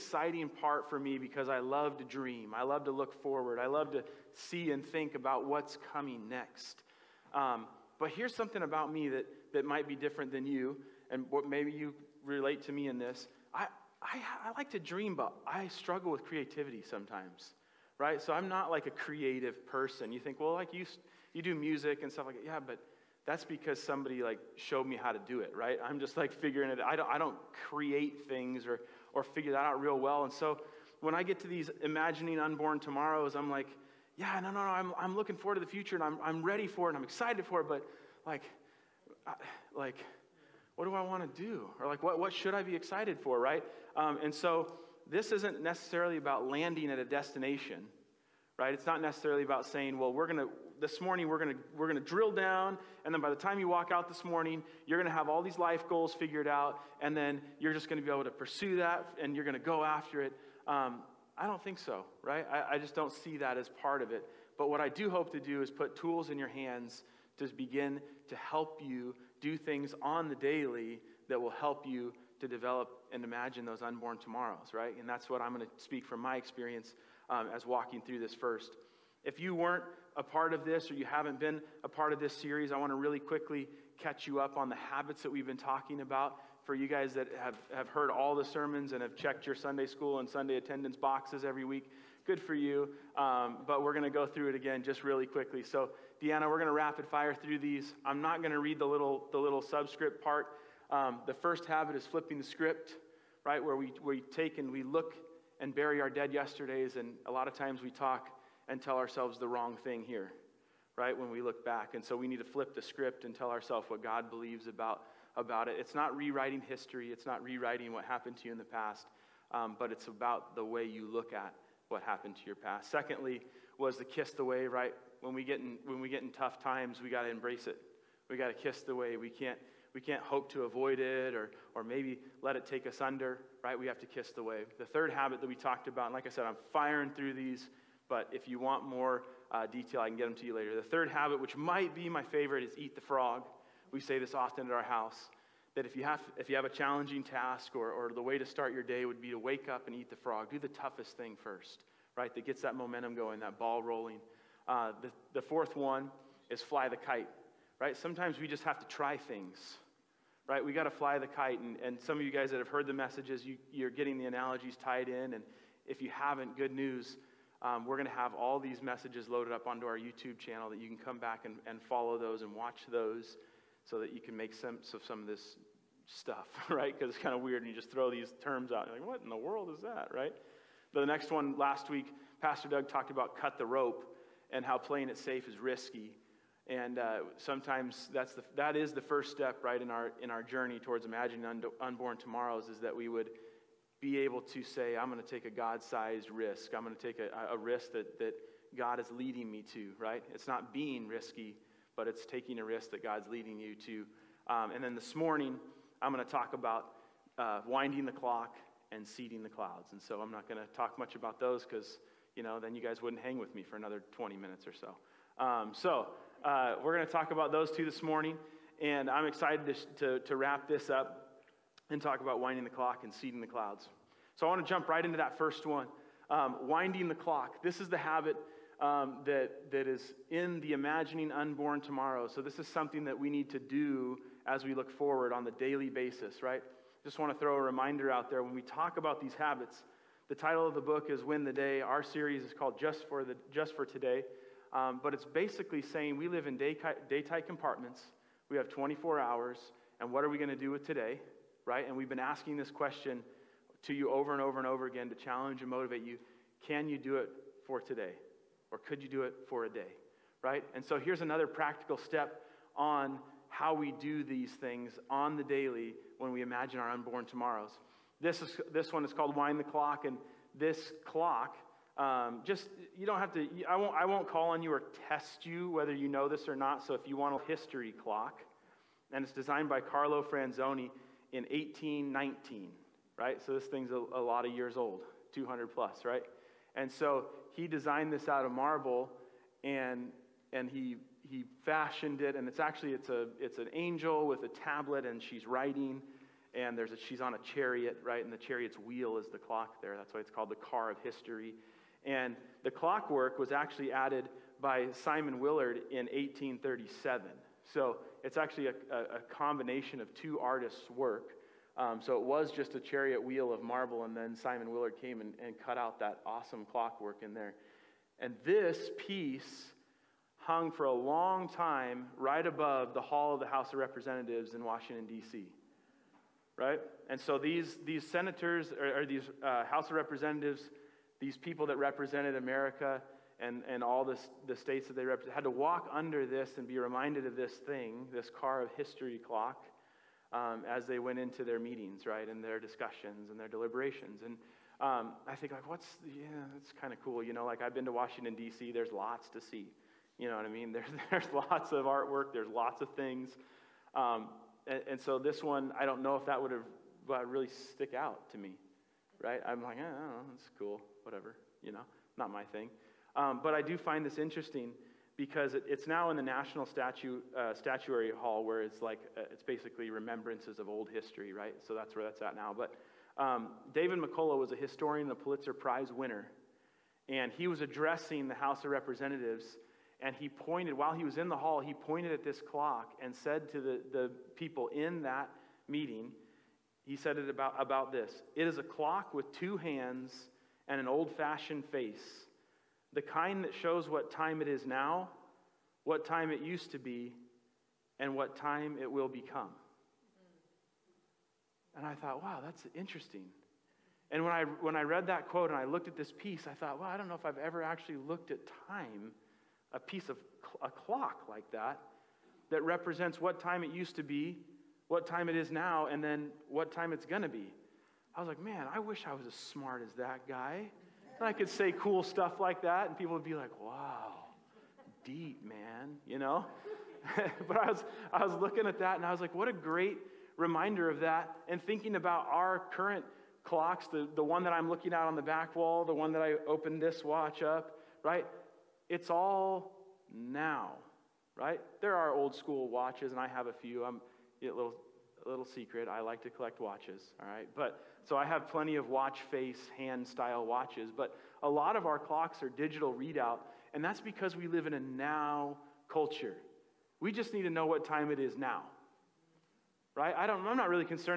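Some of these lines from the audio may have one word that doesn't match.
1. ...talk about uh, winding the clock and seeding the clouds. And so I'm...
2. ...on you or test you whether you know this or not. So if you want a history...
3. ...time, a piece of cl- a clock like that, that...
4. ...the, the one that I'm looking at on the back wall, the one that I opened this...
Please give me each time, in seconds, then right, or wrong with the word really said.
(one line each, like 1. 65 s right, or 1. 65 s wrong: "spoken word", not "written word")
1. 206 s right
2. 274 s right
3. 408 s right
4. 433 s right.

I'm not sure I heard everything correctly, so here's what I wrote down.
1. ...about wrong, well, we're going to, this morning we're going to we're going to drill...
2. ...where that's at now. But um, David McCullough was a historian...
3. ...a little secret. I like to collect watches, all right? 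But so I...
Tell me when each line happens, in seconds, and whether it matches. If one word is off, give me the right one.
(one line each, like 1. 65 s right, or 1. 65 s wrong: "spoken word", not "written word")
1. 49 s wrong: "saying", not "wrong"
2. 371 s right
3. 445 s right.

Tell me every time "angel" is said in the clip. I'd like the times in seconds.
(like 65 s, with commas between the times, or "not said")
293 s.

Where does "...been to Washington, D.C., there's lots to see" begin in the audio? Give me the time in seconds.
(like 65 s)
347 s.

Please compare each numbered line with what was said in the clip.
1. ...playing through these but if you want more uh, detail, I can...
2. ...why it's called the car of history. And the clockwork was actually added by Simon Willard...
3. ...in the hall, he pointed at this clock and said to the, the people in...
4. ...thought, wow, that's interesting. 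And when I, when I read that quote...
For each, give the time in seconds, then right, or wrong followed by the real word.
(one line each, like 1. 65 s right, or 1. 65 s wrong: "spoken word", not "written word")
1. 136 s wrong: "firing", not "playing"
2. 300 s right
3. 381 s right
4. 401 s right.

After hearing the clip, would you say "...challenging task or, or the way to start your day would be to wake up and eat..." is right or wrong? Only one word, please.
right.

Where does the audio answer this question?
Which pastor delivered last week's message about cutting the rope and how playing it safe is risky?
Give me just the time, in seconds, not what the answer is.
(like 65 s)
182 s.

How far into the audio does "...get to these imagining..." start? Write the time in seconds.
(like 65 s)
31 s.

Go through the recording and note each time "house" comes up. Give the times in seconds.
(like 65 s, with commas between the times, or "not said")
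144 s, 323 s, 329 s, 378 s.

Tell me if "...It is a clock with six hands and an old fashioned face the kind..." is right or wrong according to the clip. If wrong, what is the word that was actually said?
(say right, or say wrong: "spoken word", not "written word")
wrong: "two", not "six".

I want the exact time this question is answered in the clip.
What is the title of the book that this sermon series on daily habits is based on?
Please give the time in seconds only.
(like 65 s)
241 s.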